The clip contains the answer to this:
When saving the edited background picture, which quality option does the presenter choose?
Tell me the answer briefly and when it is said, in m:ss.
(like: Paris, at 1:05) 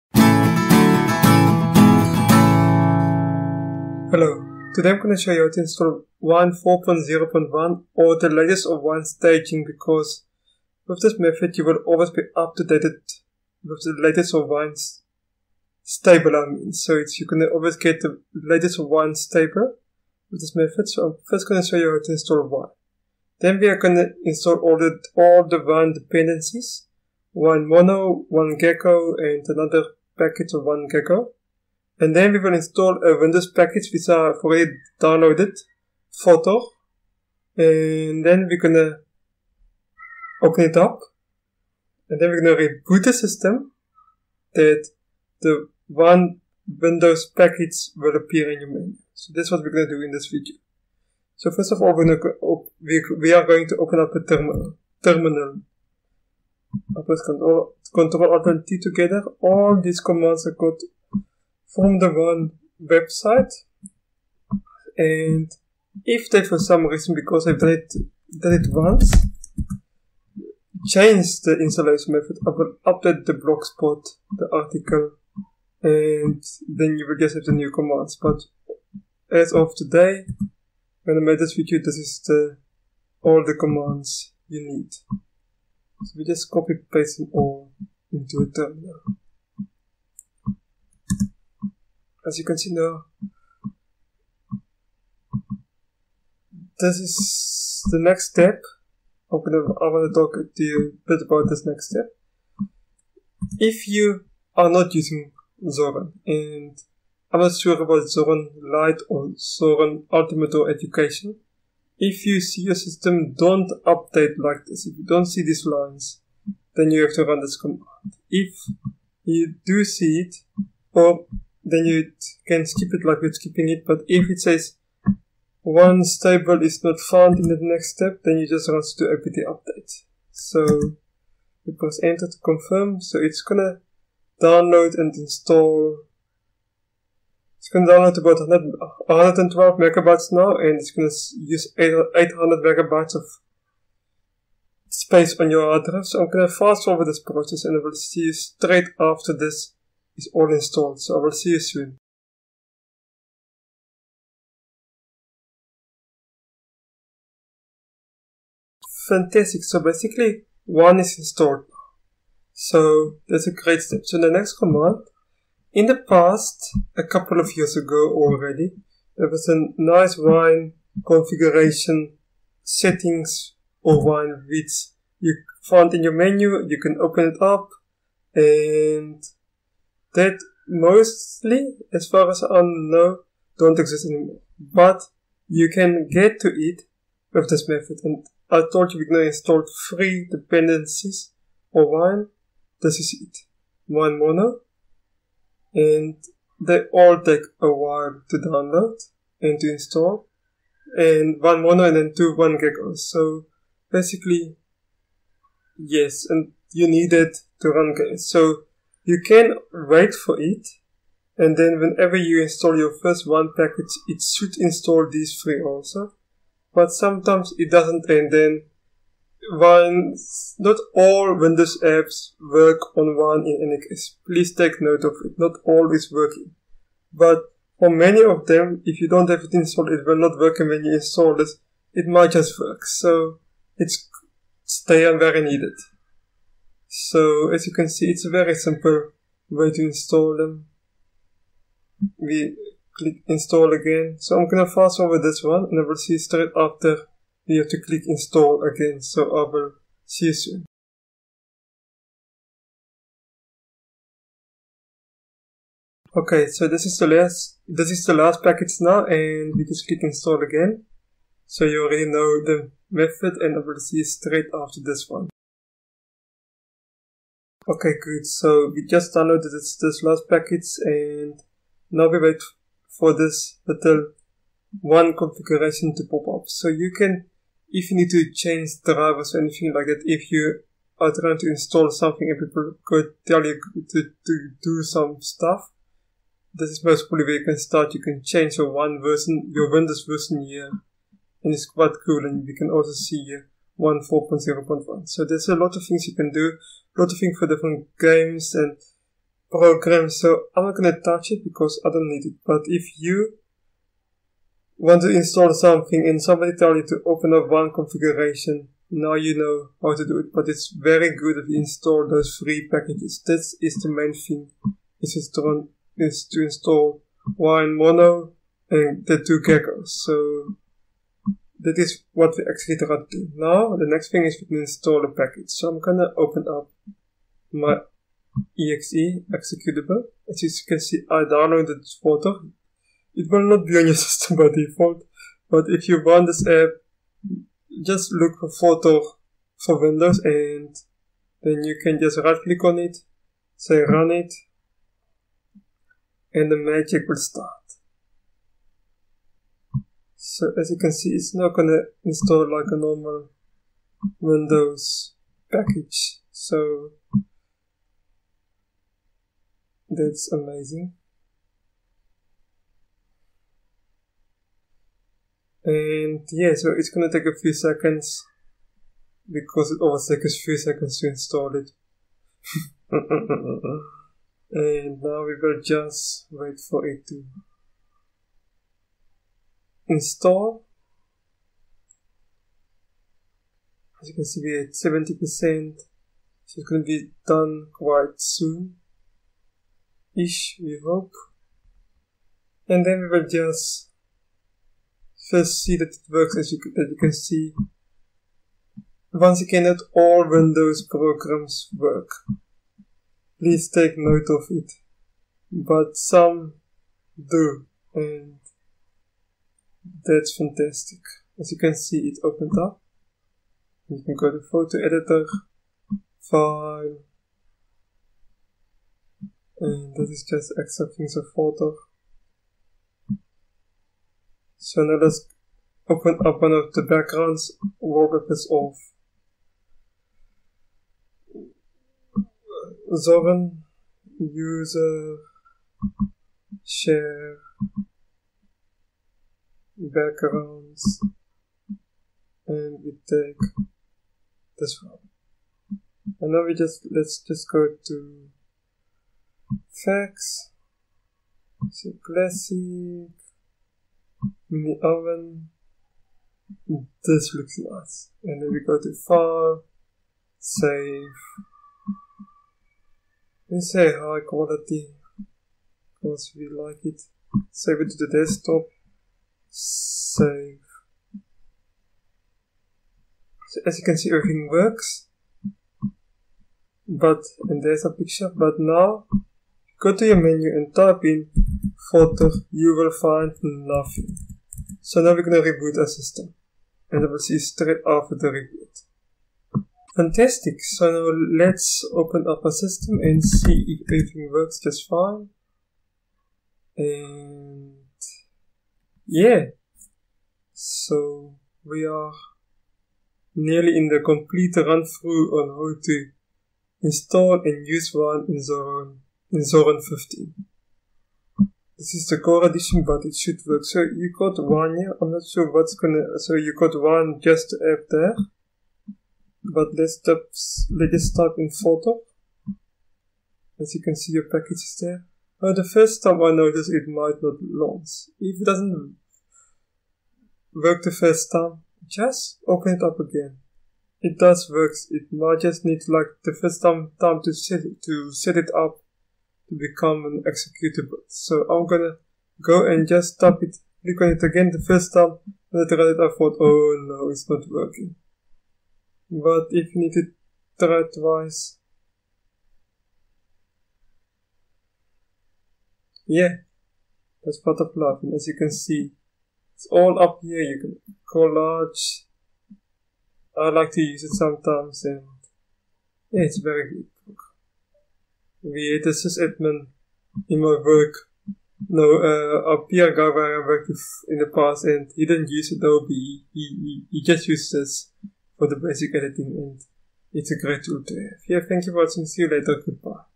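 high quality, at 7:43.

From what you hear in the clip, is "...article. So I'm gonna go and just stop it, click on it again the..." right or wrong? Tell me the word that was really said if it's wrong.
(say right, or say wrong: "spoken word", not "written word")
wrong: "executable", not "article".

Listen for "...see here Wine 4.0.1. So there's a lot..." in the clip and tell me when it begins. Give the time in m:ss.
4:52.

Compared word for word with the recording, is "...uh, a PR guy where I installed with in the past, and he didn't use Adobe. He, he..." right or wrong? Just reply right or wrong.
wrong.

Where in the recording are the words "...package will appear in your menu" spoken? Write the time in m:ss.
0:47.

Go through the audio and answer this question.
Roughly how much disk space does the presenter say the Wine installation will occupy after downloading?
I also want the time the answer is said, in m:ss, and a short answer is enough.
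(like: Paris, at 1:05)
800 megabytes, at 2:21.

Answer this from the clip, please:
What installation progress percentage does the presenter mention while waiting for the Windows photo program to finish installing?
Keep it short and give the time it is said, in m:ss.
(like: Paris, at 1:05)
70 percent, at 6:24.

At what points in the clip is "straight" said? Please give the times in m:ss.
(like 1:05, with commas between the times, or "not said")
2:28, 4:06, 4:24, 8:07.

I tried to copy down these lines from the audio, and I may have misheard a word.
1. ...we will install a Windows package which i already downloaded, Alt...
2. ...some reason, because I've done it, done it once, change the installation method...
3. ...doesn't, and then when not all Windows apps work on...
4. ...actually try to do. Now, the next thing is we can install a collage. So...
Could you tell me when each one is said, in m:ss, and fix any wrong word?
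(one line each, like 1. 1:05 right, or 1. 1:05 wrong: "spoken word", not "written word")
1. 0:32 wrong: "Photo", not "Alt"
2. 1:06 right
3. 3:37 right
4. 5:22 wrong: "package", not "collage".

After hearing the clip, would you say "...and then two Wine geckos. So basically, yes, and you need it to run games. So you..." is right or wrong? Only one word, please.
right.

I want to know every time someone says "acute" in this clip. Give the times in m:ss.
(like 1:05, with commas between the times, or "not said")
not said.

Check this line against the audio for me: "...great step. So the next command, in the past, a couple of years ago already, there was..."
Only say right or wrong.
right.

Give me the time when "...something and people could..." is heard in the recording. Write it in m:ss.
4:41.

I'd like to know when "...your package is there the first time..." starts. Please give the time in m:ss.
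8:44.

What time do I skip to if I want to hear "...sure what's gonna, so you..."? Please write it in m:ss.
8:35.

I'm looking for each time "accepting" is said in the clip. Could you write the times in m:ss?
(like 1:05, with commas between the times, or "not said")
7:00.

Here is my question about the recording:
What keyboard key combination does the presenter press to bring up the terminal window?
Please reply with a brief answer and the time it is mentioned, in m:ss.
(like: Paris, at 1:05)
Control Alt T, at 0:57.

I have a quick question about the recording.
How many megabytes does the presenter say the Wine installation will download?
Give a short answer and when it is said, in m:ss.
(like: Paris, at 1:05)
112, at 2:19.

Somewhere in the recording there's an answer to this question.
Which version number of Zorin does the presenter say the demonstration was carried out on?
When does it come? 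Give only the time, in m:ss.
8:29.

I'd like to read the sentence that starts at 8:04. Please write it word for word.
So now we're gonna reboot our system.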